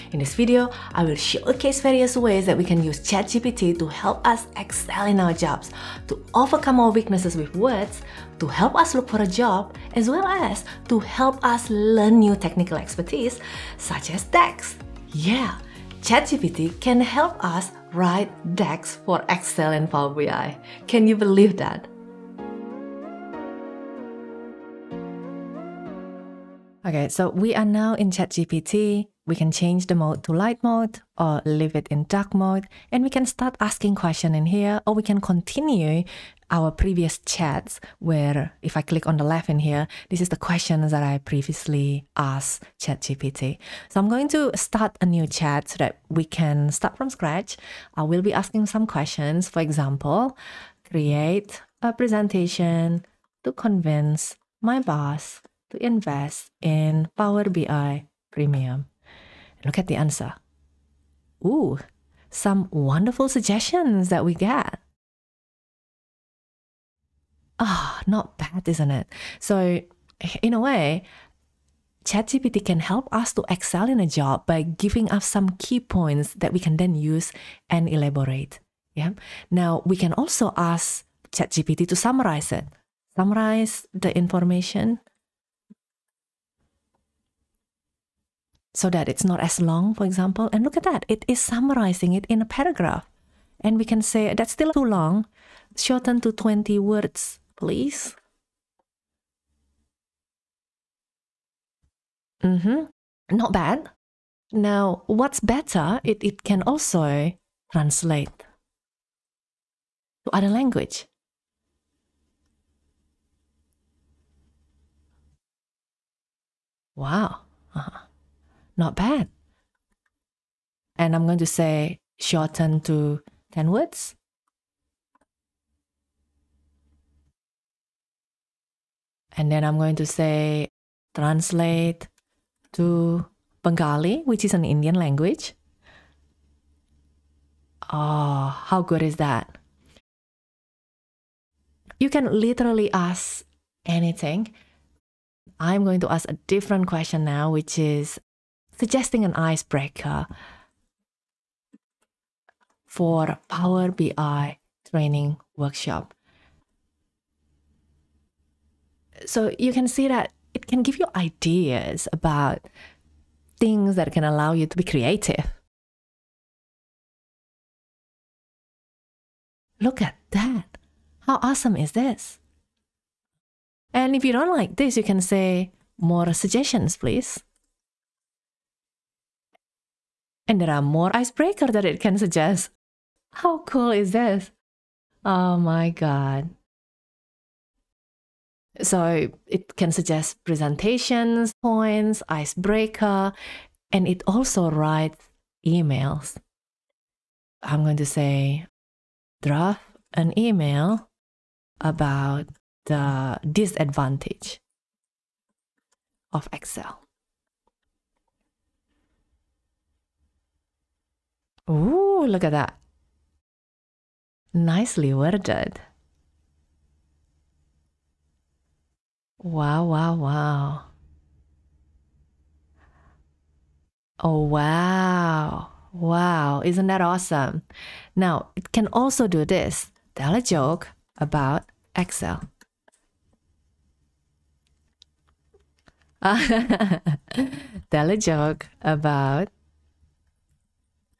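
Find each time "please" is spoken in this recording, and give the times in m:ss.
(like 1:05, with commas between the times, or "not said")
1:37, 2:56.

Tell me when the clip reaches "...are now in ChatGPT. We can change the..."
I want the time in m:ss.
0:27.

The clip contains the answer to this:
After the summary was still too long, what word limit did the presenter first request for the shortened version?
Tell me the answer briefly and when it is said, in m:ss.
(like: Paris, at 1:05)
20 words, at 1:36.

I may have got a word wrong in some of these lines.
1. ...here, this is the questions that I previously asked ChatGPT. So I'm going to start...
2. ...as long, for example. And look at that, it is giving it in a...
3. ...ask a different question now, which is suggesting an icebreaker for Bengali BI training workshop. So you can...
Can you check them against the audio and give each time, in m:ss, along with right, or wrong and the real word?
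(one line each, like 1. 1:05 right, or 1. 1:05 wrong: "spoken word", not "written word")
1. 0:39 right
2. 1:29 wrong: "summarizing", not "giving"
3. 2:26 wrong: "Power", not "Bengali".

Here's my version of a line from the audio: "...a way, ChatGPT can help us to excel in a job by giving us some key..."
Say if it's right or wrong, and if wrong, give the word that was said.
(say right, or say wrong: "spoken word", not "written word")
right.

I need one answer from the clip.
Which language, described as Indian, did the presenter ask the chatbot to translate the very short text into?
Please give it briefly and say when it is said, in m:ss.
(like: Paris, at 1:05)
Bengali, at 2:13.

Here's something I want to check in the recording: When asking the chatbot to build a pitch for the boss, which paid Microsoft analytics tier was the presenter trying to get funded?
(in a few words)
Power BI Premium.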